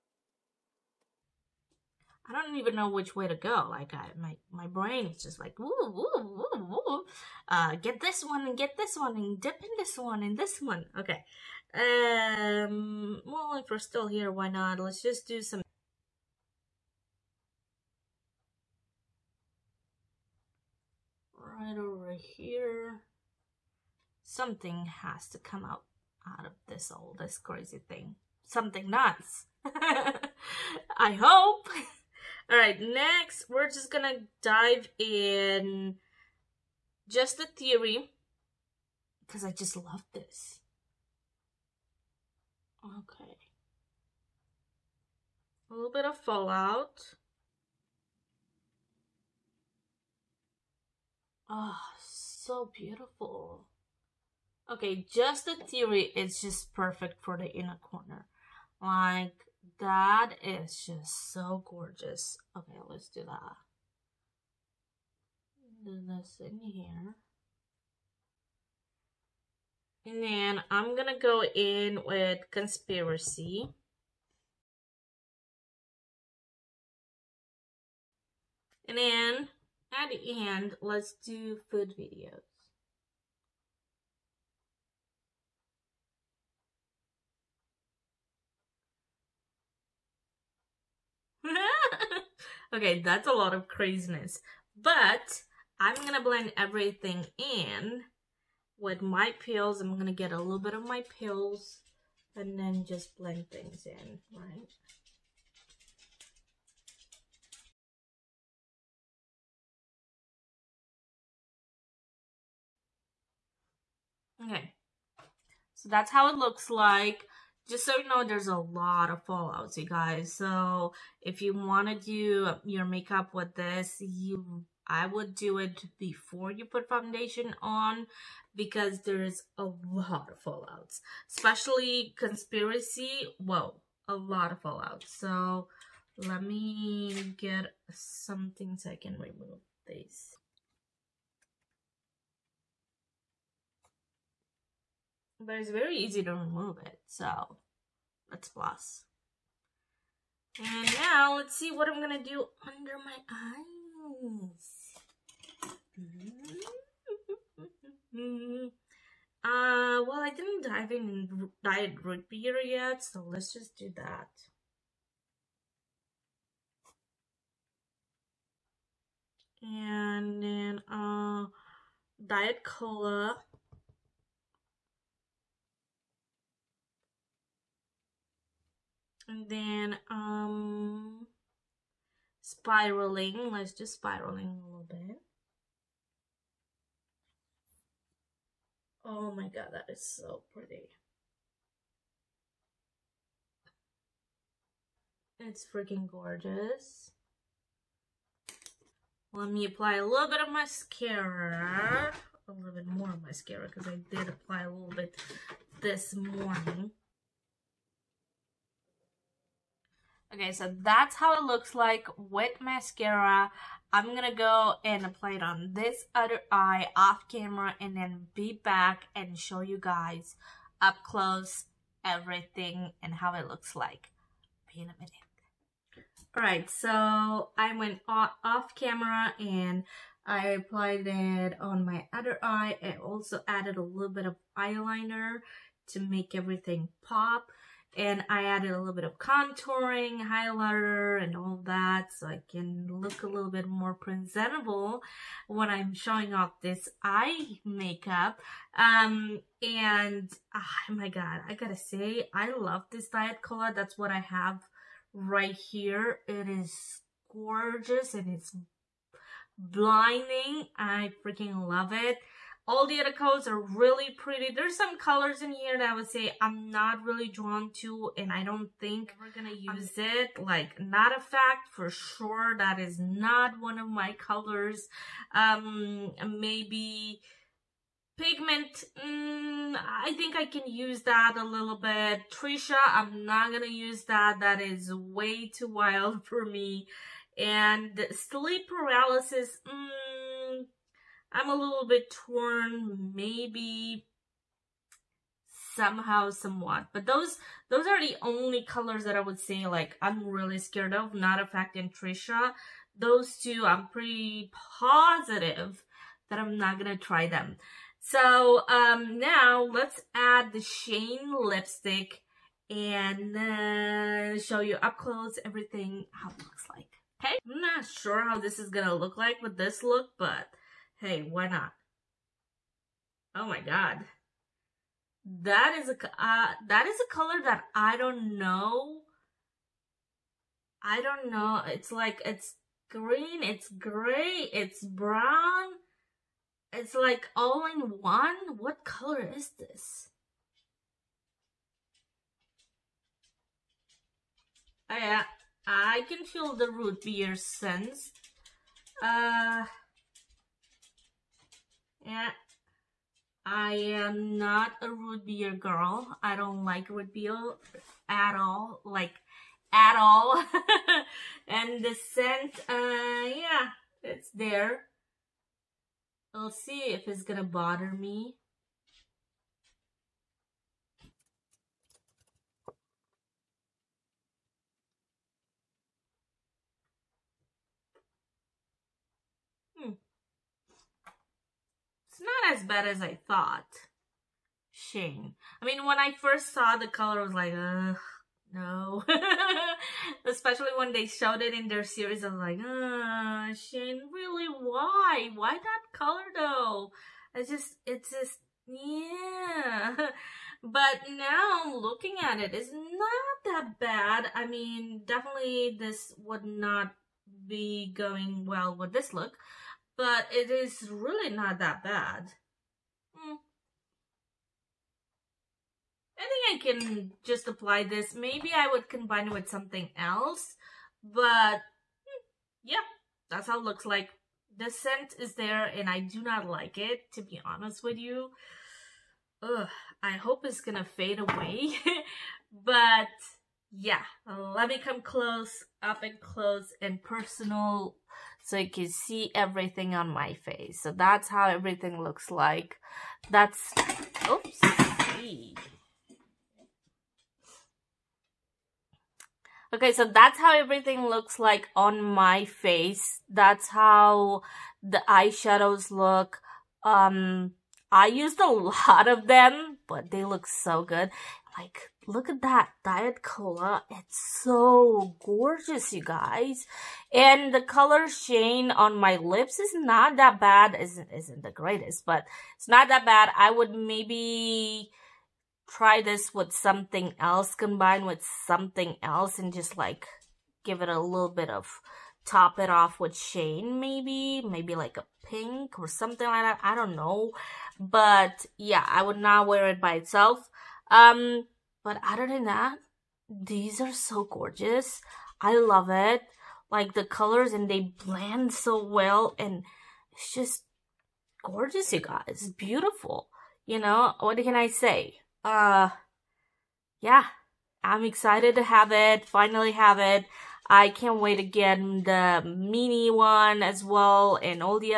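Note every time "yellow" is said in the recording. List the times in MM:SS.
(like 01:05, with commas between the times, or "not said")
not said.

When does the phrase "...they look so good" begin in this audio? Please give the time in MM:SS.
07:40.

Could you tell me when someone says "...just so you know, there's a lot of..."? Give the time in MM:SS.
01:57.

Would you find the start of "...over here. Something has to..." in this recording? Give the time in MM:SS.
00:21.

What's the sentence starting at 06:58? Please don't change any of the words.
Maybe I would combine it with something else, but mm, yeah, that's how it looks like.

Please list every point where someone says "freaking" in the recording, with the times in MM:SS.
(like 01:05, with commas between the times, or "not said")
03:15, 04:21.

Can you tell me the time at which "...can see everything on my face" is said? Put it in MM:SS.
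07:18.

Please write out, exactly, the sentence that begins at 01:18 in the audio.
And then at the end, let's do food videos.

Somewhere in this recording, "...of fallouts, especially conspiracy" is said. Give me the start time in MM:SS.
02:10.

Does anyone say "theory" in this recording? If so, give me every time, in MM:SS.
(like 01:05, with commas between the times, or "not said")
00:37, 00:55.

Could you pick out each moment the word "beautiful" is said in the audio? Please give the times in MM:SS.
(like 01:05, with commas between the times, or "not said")
00:52, 08:22.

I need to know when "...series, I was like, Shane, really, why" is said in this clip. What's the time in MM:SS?
06:31.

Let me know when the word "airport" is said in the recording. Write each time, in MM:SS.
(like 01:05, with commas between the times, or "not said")
not said.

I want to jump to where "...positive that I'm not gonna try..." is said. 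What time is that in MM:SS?
05:04.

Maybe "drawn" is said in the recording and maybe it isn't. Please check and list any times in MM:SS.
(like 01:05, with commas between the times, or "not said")
04:27.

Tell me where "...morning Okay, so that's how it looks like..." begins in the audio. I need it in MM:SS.
03:26.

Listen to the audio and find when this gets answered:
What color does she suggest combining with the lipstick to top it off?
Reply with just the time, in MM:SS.
08:04.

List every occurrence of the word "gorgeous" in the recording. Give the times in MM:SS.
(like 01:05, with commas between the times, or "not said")
01:01, 03:16, 04:17, 07:45, 08:14, 08:21.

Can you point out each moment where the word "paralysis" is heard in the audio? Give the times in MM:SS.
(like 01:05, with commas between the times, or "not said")
04:48.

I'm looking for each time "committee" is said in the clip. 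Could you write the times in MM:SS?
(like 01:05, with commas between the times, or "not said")
not said.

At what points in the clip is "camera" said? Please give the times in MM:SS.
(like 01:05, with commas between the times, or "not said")
03:37, 03:48.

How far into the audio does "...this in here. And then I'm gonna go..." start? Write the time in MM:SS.
01:06.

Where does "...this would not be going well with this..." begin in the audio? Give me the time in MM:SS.
06:45.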